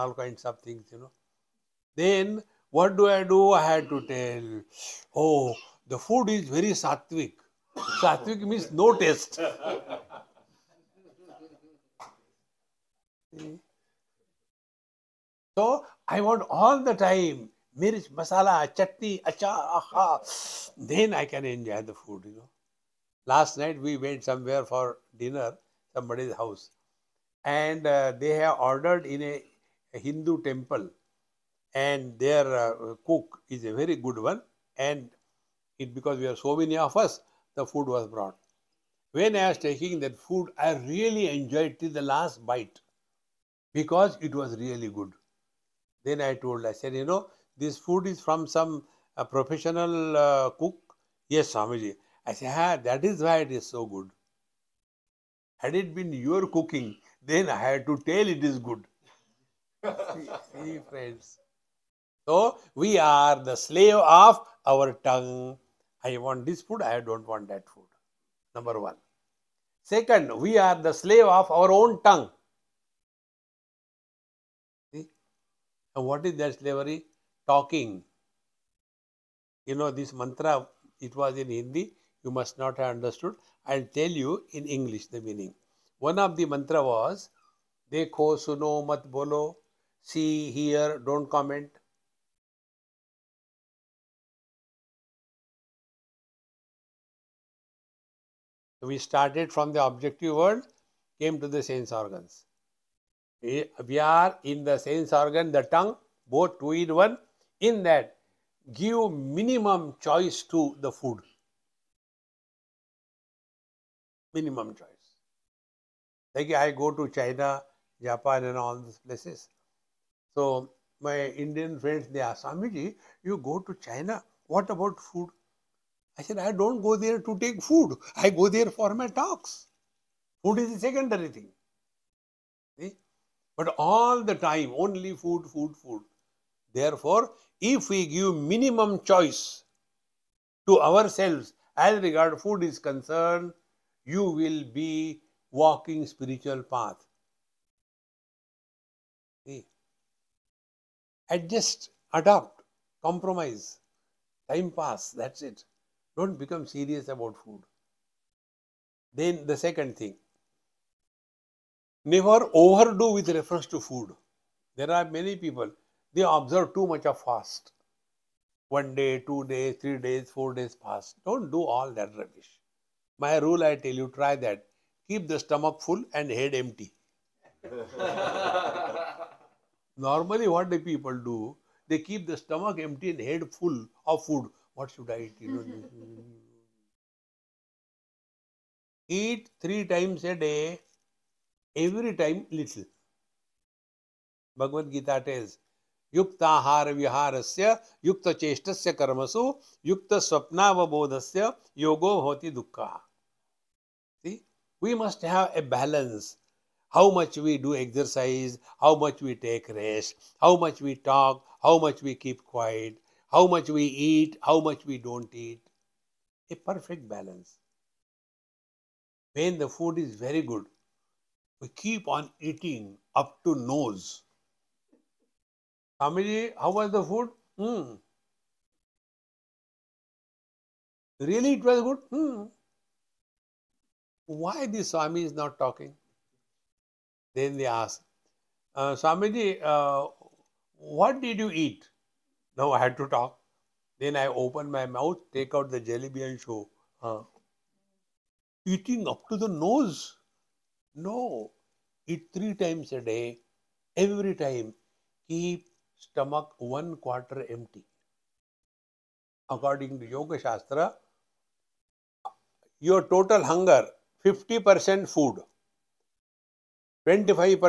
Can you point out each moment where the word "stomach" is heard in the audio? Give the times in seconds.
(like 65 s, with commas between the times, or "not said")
175 s, 182 s, 256 s.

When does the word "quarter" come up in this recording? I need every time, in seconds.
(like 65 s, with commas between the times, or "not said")
256 s.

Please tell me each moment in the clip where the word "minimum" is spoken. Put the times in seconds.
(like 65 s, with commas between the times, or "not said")
109 s, 114 s, 138 s.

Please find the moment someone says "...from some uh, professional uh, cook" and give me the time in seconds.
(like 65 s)
48 s.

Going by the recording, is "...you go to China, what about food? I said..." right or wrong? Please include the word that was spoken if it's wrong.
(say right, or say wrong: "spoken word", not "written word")
right.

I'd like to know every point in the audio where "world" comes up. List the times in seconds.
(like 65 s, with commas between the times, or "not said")
100 s.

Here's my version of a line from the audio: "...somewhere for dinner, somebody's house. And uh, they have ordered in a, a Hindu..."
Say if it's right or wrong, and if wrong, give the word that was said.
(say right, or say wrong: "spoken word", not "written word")
right.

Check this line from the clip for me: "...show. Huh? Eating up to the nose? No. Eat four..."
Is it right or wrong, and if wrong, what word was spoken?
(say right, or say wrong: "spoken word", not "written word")
wrong: "three", not "four".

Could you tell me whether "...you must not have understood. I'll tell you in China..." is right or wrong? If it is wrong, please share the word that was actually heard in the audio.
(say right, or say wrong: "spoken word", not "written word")
wrong: "English", not "China".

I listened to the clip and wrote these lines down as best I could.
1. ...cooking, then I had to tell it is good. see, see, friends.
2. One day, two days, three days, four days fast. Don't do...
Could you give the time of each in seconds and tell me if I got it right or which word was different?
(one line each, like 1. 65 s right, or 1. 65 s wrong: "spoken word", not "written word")
1. 56 s right
2. 168 s right.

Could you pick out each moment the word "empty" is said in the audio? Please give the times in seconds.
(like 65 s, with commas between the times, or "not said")
176 s, 182 s, 257 s.